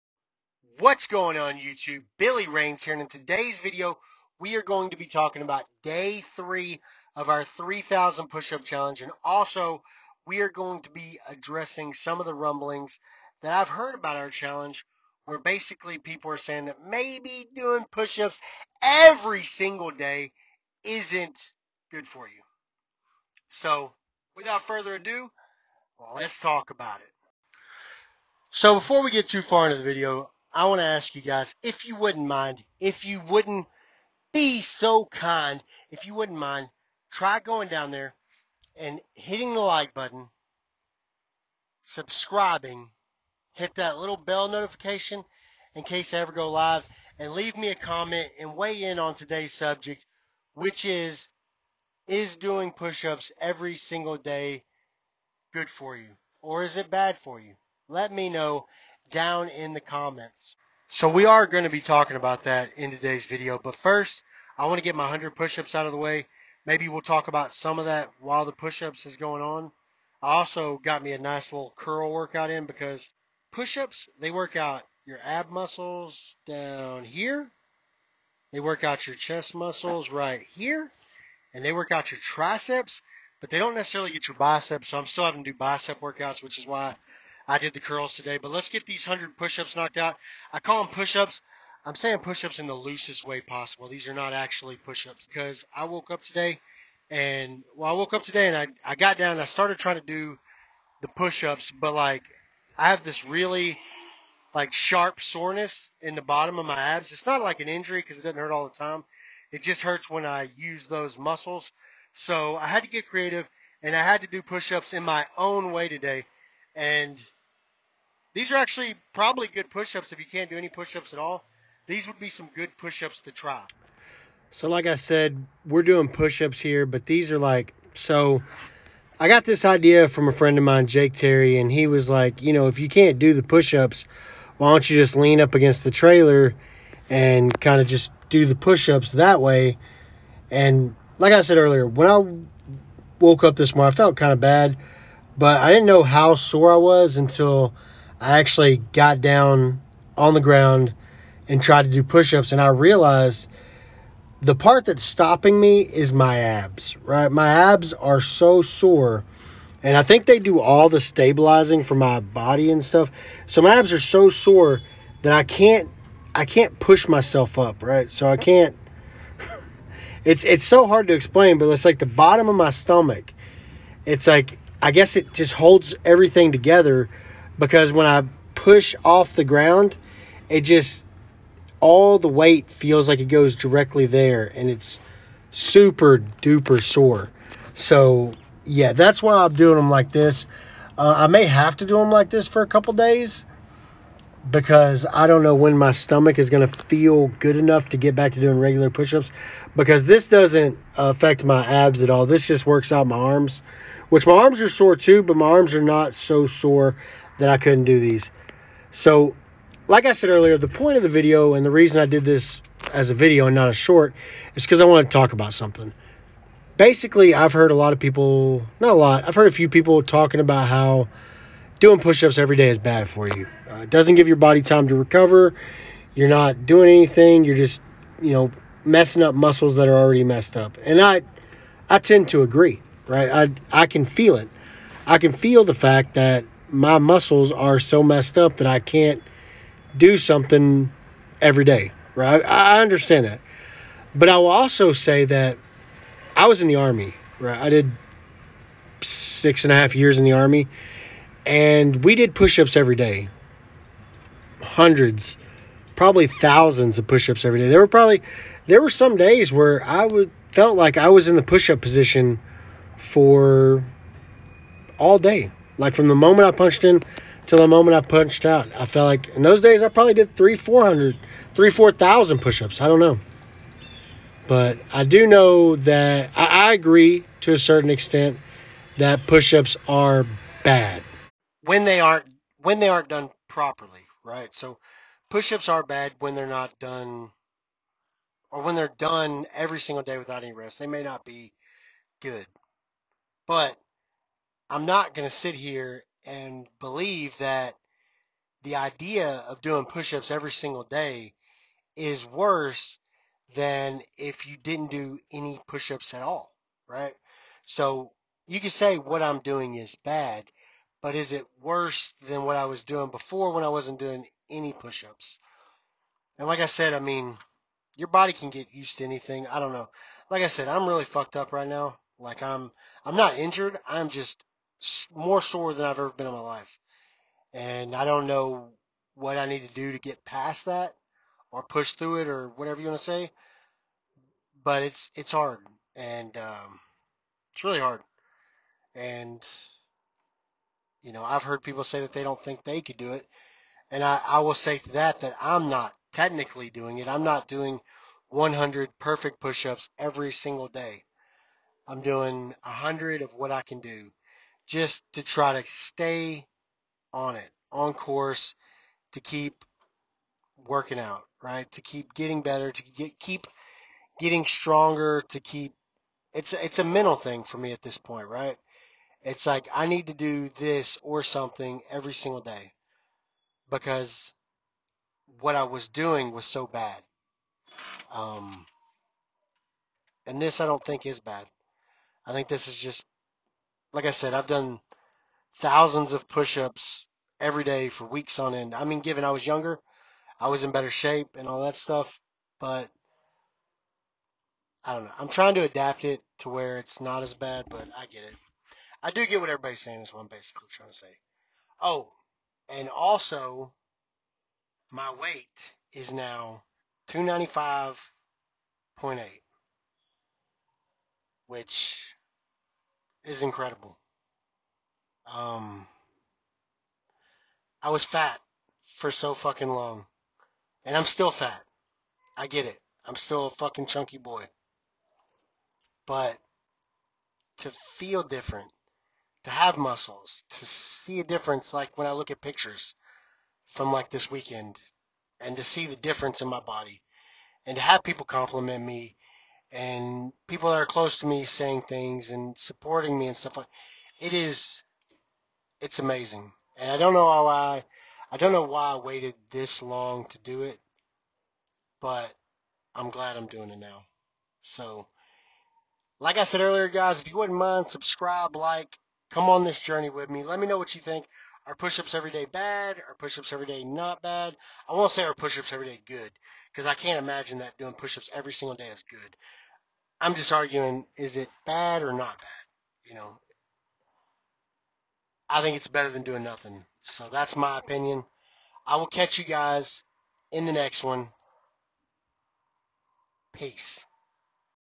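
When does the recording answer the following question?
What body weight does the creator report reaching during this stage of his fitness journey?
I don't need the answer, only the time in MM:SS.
06:47.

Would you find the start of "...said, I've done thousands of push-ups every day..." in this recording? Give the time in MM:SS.
06:24.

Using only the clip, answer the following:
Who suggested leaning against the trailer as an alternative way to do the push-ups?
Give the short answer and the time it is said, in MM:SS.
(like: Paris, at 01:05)
Jake Terry, at 02:10.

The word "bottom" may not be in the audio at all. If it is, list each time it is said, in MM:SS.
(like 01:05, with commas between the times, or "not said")
01:46, 02:52.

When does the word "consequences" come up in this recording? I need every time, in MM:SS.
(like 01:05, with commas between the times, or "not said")
not said.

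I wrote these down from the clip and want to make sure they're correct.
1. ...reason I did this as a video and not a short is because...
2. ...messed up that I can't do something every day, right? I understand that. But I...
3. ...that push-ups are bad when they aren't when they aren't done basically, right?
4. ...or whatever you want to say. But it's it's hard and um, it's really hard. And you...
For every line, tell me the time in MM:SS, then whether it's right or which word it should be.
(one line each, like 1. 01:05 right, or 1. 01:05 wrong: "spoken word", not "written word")
1. 03:31 right
2. 03:58 right
3. 04:38 wrong: "properly", not "basically"
4. 05:32 right.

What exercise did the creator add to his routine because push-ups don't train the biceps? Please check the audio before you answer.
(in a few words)
curls.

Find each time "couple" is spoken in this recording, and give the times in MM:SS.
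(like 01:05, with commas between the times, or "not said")
03:12.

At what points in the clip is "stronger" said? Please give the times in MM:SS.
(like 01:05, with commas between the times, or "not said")
06:04.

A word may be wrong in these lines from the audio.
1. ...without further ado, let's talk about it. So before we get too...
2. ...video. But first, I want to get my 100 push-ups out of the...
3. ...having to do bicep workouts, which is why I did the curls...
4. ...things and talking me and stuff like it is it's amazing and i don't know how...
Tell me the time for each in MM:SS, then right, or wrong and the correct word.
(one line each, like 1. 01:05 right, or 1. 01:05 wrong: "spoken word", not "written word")
1. 00:24 right
2. 01:03 right
3. 01:25 right
4. 07:21 wrong: "supporting", not "talking".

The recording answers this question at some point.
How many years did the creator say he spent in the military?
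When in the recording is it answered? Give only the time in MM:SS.
04:09.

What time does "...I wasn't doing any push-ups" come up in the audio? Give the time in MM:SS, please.
05:13.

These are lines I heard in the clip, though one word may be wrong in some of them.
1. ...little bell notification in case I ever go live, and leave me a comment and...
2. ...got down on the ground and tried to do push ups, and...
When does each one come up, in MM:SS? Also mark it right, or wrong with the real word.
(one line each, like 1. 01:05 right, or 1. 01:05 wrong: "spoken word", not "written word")
1. 00:43 right
2. 02:28 right.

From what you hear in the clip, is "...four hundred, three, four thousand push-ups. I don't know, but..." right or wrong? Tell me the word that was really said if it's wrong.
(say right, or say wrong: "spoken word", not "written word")
right.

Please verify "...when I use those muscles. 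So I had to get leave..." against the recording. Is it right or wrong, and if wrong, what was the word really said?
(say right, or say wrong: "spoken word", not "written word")
wrong: "creative", not "leave".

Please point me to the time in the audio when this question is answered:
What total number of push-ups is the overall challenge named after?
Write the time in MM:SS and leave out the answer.
00:07.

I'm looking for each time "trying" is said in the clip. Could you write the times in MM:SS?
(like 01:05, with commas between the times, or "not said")
01:39, 06:35, 06:40.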